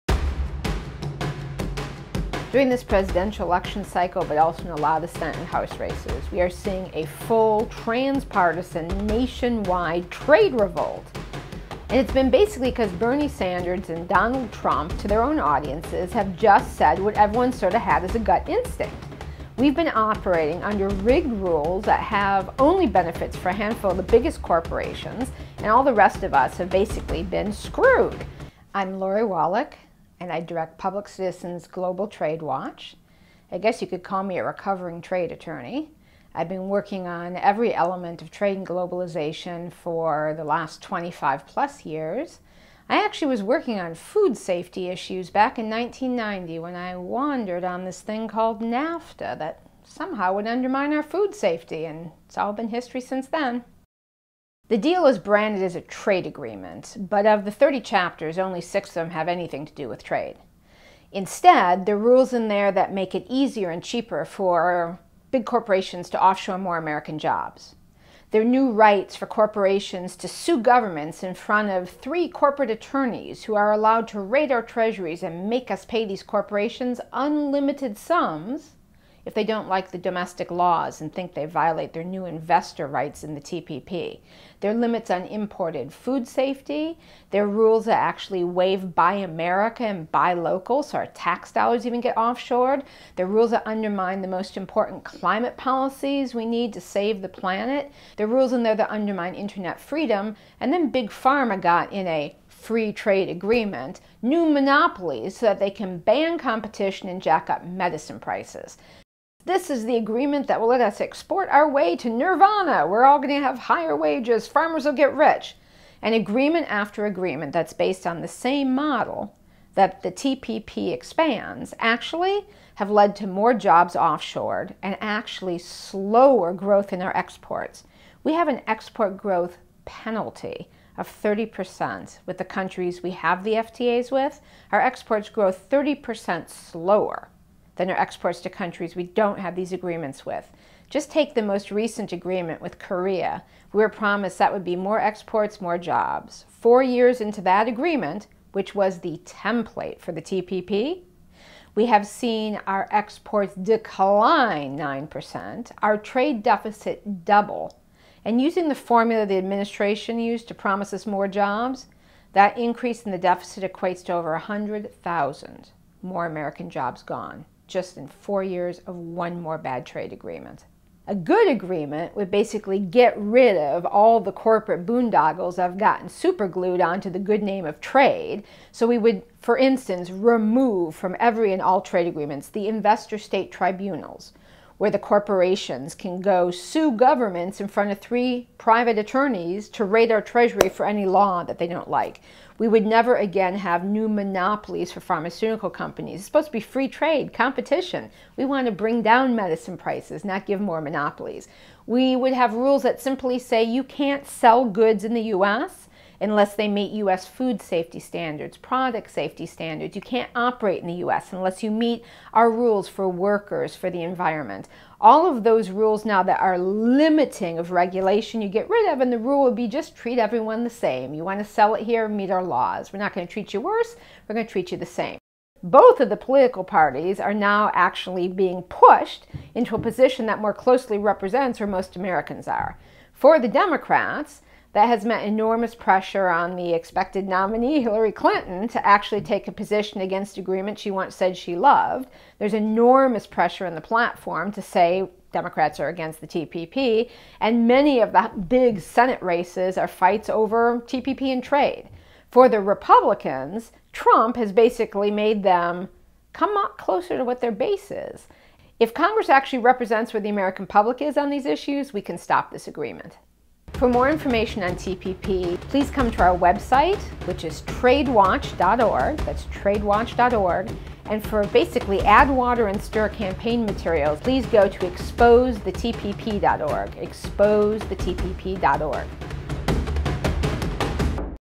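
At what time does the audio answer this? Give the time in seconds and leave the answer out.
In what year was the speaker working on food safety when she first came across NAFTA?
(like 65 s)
45 s.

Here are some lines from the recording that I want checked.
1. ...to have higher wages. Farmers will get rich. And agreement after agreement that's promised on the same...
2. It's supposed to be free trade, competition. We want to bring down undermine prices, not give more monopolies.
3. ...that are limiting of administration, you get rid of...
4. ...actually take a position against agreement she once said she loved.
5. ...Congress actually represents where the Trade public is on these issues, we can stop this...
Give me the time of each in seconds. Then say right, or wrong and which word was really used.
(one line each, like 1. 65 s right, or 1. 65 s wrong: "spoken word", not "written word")
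1. 113 s wrong: "based", not "promised"
2. 196 s wrong: "medicine", not "undermine"
3. 216 s wrong: "regulation", not "administration"
4. 238 s right
5. 258 s wrong: "American", not "Trade".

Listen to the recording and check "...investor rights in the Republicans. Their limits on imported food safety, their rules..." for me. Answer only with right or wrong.
wrong.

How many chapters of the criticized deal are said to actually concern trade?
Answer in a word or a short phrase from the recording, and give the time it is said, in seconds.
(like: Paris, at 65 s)
6, at 58 s.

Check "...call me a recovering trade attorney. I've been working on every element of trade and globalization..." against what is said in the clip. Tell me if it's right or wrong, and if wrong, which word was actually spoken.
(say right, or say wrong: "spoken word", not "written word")
right.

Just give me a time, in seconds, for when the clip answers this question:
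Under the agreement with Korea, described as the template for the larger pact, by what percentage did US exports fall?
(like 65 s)
154 s.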